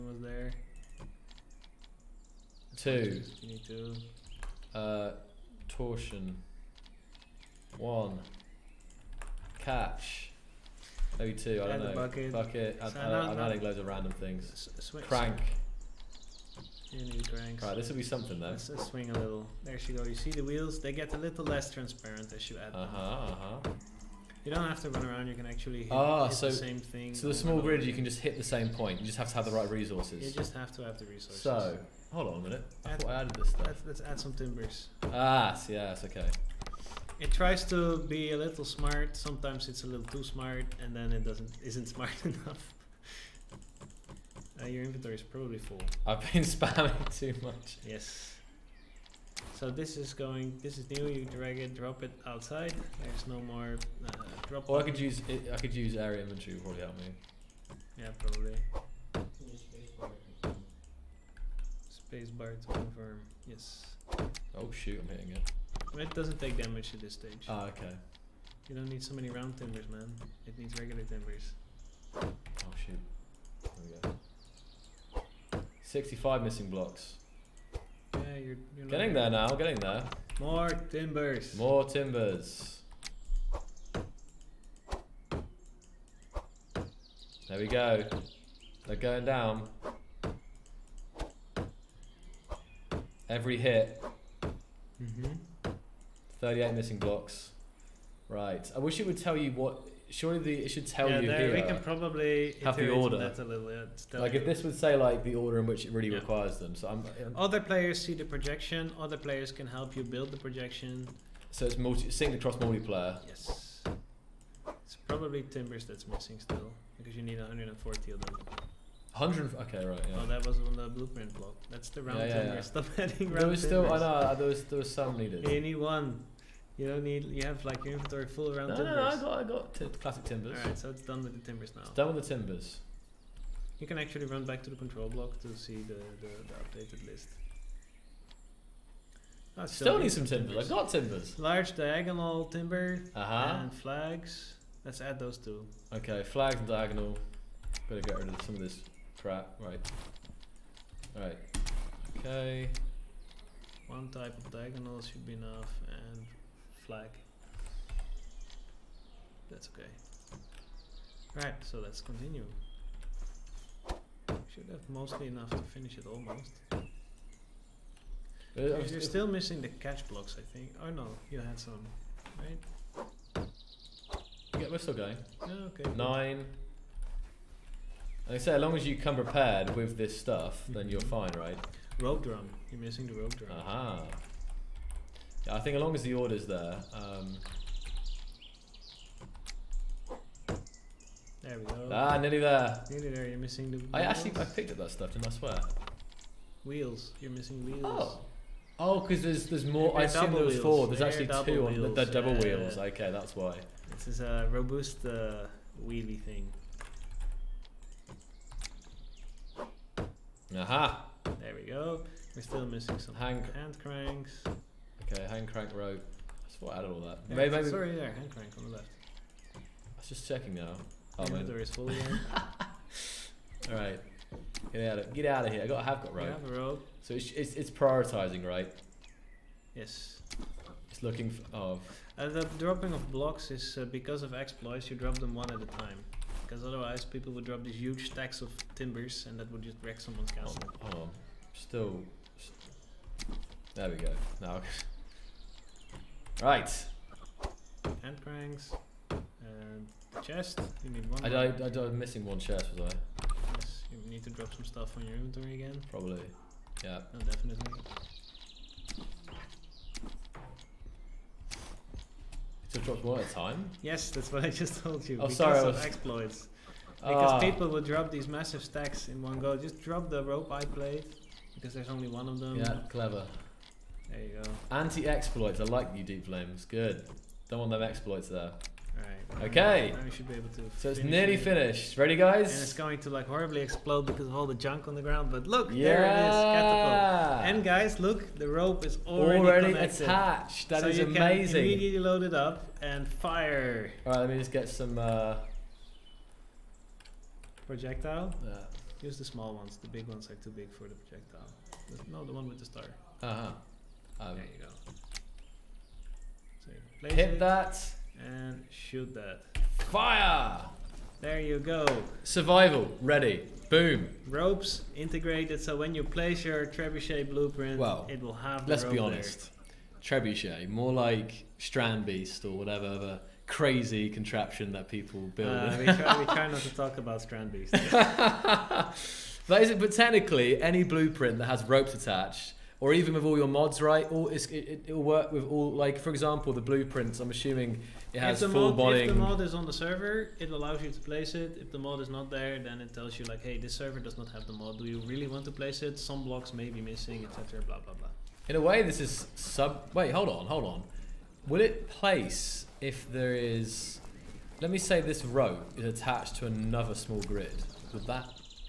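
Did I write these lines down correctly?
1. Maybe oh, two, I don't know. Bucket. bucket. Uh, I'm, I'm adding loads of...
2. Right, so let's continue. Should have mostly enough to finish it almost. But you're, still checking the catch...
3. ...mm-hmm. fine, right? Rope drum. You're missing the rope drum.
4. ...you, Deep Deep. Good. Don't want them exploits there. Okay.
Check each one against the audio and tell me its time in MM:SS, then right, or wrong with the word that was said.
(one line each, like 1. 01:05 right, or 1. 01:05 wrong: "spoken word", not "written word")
1. 00:11 right
2. 02:41 wrong: "missing", not "checking"
3. 03:01 right
4. 04:35 wrong: "Flames", not "Deep".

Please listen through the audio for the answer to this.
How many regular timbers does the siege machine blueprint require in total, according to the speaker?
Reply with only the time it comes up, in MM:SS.
01:57.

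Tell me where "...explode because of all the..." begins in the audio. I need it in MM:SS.
04:43.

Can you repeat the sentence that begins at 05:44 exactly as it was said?
Do you really want to place it?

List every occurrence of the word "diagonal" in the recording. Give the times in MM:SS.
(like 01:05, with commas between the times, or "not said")
02:21, 02:26, 02:34.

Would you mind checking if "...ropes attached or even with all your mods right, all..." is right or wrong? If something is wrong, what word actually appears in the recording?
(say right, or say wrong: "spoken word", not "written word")
right.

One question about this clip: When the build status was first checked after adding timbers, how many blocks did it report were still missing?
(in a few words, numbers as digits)
65.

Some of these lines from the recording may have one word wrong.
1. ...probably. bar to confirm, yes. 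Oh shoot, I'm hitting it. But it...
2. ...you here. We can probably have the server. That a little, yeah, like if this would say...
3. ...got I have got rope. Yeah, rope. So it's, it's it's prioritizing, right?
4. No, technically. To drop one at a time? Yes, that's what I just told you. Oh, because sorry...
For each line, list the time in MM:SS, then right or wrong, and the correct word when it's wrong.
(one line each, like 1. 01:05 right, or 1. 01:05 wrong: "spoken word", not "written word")
1. 00:58 right
2. 01:41 wrong: "order", not "server"
3. 03:45 right
4. 04:17 wrong: "definitely", not "technically".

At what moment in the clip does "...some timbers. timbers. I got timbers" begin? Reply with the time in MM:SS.
02:20.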